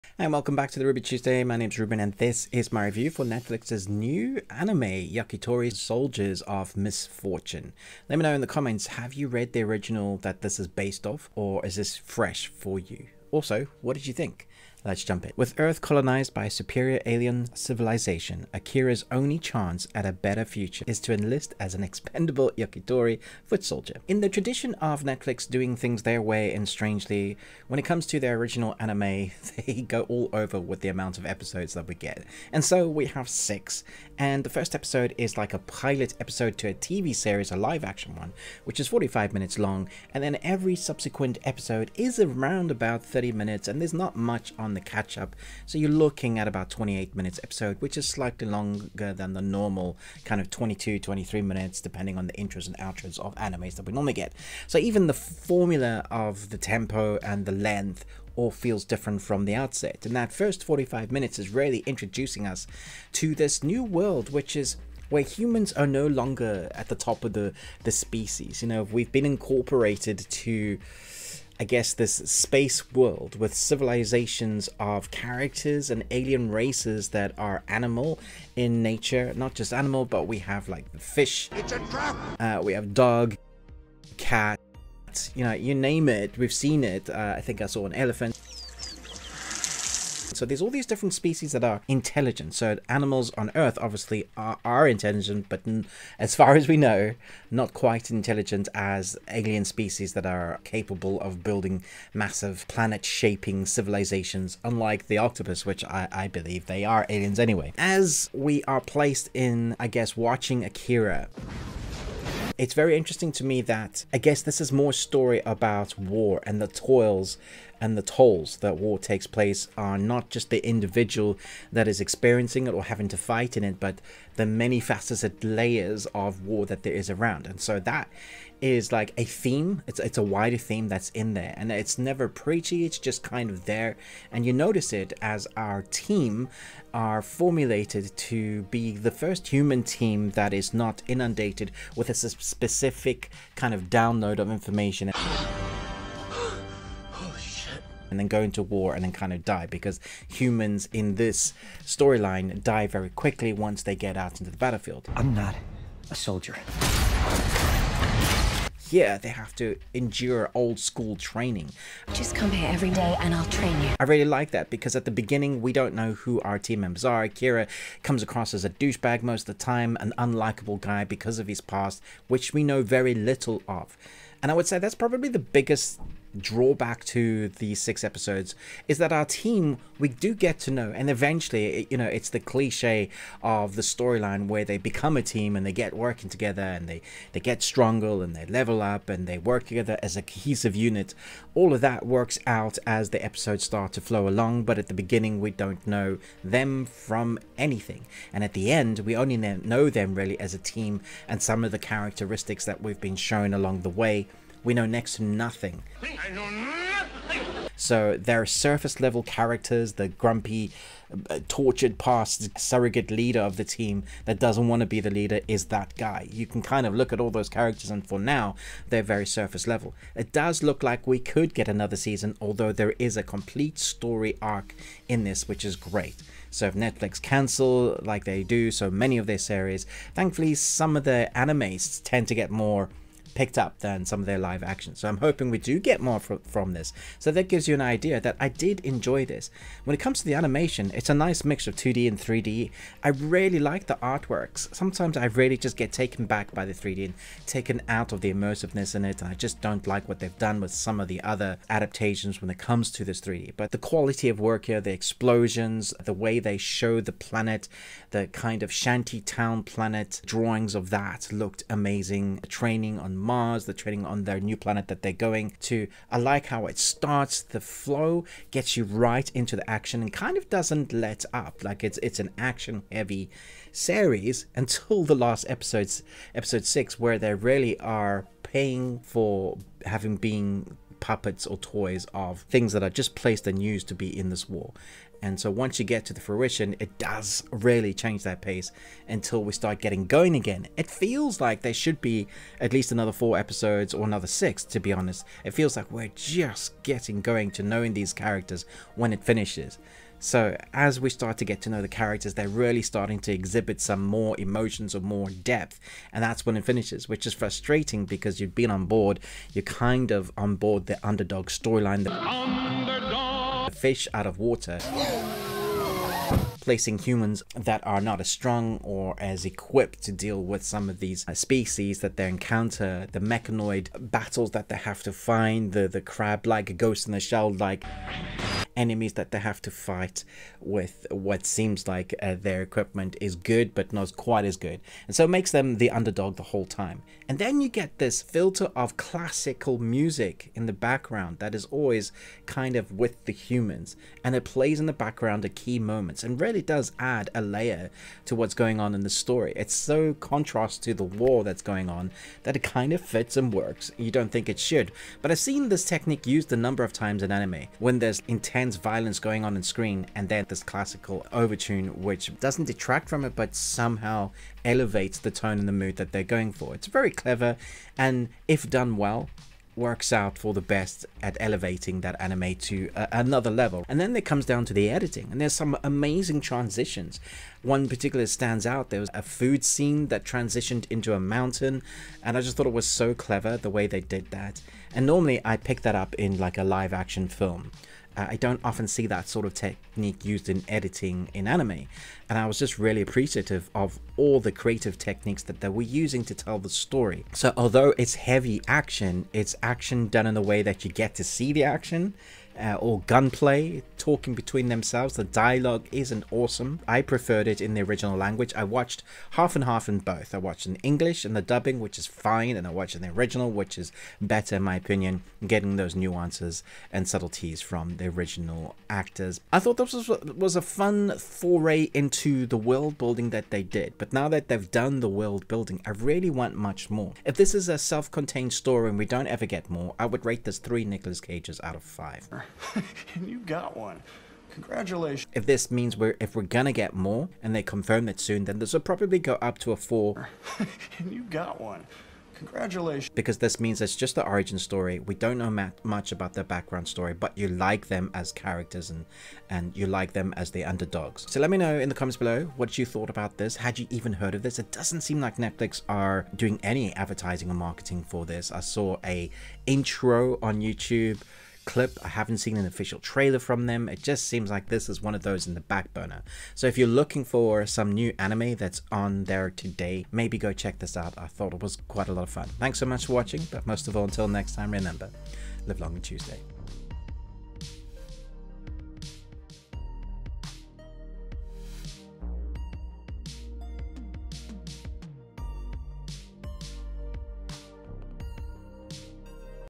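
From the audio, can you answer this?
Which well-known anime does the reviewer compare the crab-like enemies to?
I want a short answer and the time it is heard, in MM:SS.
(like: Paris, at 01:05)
Ghost in the Shell, at 05:26.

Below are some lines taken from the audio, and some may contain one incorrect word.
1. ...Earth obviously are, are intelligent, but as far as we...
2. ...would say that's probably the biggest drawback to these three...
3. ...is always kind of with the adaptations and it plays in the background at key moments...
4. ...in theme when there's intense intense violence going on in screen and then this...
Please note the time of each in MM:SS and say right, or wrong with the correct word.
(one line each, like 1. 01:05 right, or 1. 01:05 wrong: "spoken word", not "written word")
1. 01:33 right
2. 02:54 wrong: "six", not "three"
3. 05:41 wrong: "humans", not "adaptations"
4. 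05:57 wrong: "anime", not "theme".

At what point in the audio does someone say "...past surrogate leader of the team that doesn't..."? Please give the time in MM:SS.
03:31.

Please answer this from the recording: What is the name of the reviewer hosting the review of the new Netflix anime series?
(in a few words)
Ruben.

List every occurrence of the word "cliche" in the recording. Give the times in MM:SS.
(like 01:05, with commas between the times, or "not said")
03:02.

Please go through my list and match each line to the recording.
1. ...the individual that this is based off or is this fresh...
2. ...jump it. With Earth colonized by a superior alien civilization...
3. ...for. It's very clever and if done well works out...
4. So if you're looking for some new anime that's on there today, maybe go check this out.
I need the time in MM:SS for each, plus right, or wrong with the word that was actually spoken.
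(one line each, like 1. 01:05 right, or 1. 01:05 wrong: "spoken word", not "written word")
1. 00:09 wrong: "original", not "individual"
2. 00:15 right
3. 06:06 right
4. 07:46 right.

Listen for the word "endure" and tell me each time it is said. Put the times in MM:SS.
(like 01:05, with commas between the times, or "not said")
02:39.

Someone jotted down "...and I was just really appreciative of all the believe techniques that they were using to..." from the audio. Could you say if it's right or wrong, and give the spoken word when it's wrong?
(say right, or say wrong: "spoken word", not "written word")
wrong: "creative", not "believe".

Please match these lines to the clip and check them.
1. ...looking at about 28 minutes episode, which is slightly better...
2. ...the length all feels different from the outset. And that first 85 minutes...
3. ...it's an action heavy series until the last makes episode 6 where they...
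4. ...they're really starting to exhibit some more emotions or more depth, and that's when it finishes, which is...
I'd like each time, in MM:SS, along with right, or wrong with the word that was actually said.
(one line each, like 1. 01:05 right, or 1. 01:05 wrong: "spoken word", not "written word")
1. 00:46 wrong: "longer", not "better"
2. 00:57 wrong: "45", not "85"
3. 04:32 wrong: "episodes", not "makes"
4. 05:02 right.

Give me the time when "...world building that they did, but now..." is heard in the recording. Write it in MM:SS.
07:02.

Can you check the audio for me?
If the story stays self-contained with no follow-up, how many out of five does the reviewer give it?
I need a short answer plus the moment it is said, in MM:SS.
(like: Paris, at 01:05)
3, at 07:10.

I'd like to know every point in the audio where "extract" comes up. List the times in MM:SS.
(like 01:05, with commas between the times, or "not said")
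not said.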